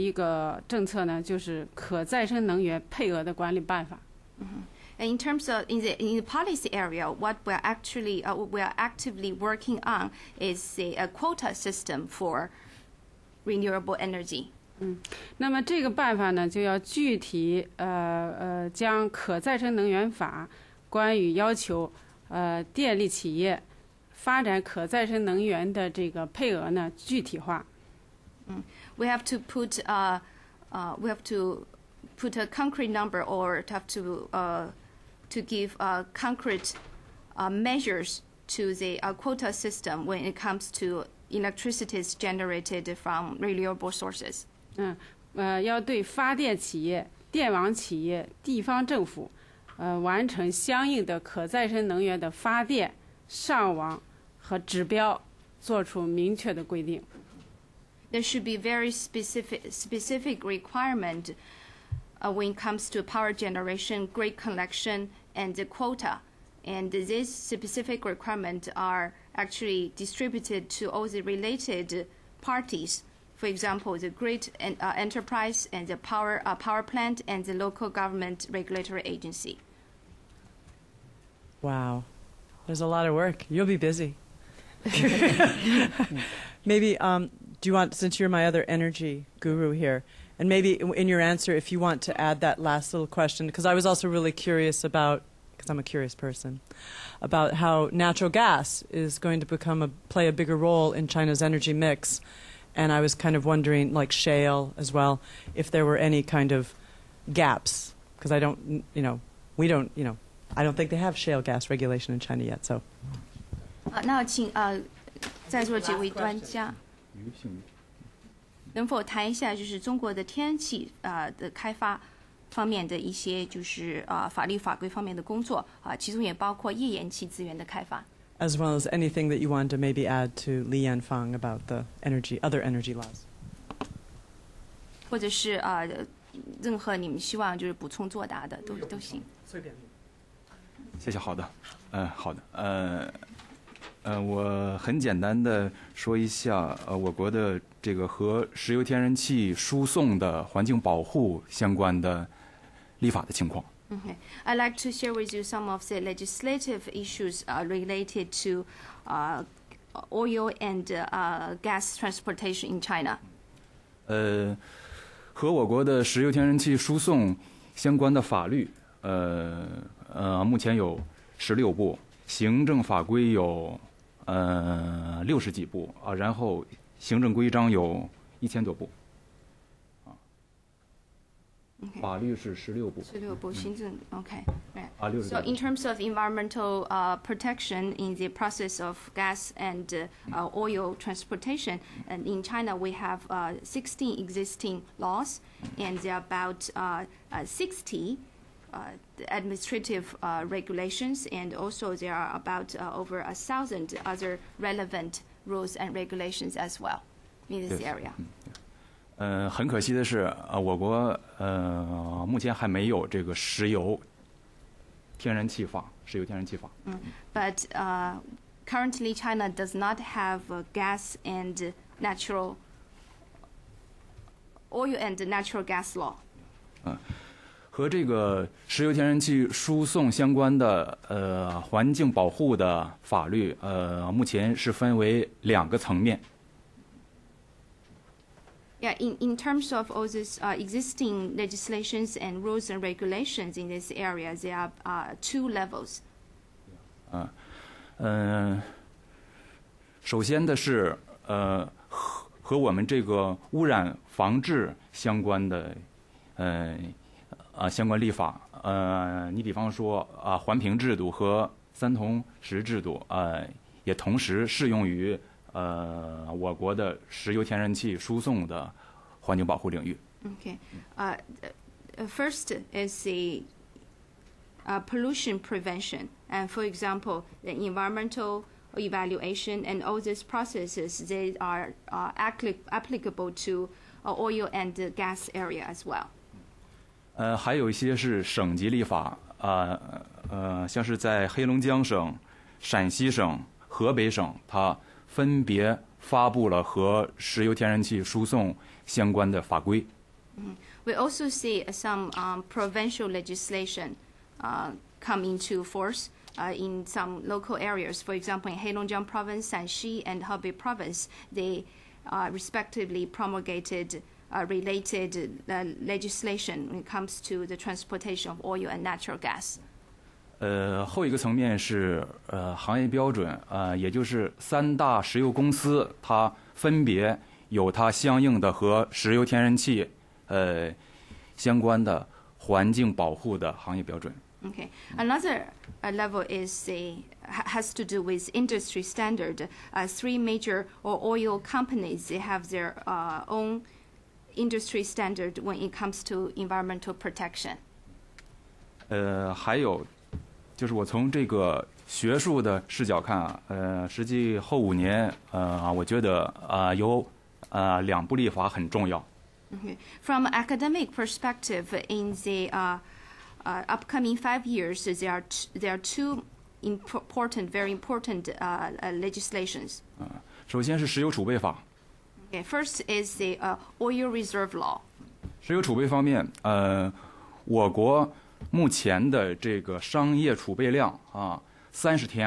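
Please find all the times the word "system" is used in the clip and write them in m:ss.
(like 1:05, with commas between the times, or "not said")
0:11, 0:39.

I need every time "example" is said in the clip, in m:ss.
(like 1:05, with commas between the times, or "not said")
1:13, 4:36, 5:08.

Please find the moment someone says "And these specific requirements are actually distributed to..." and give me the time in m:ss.
1:06.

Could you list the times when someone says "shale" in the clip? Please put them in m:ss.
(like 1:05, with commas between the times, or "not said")
1:44, 1:51.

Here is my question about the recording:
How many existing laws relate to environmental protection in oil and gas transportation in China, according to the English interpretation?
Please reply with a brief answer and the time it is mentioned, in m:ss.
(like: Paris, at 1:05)
16, at 3:13.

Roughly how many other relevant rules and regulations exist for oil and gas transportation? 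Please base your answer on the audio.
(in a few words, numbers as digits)
over a thousand.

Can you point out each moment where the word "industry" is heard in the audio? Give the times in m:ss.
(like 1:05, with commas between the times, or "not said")
5:38, 5:44.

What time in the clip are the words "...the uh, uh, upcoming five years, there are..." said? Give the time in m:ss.
6:02.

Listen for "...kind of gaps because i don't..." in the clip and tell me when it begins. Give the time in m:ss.
1:46.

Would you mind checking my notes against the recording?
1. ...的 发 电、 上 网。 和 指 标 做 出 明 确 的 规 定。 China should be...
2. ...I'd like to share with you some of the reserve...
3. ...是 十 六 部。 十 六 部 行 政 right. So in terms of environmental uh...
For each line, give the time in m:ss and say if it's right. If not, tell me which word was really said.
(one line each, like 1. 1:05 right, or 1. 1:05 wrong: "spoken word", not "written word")
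1. 0:52 wrong: "There", not "China"
2. 2:34 wrong: "legislative", not "reserve"
3. 3:02 right.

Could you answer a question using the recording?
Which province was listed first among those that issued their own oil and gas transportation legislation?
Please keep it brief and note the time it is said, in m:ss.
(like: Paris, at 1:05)
Heilongjiang, at 5:08.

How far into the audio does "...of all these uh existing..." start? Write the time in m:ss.
3:59.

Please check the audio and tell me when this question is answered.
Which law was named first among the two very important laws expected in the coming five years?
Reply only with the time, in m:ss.
6:13.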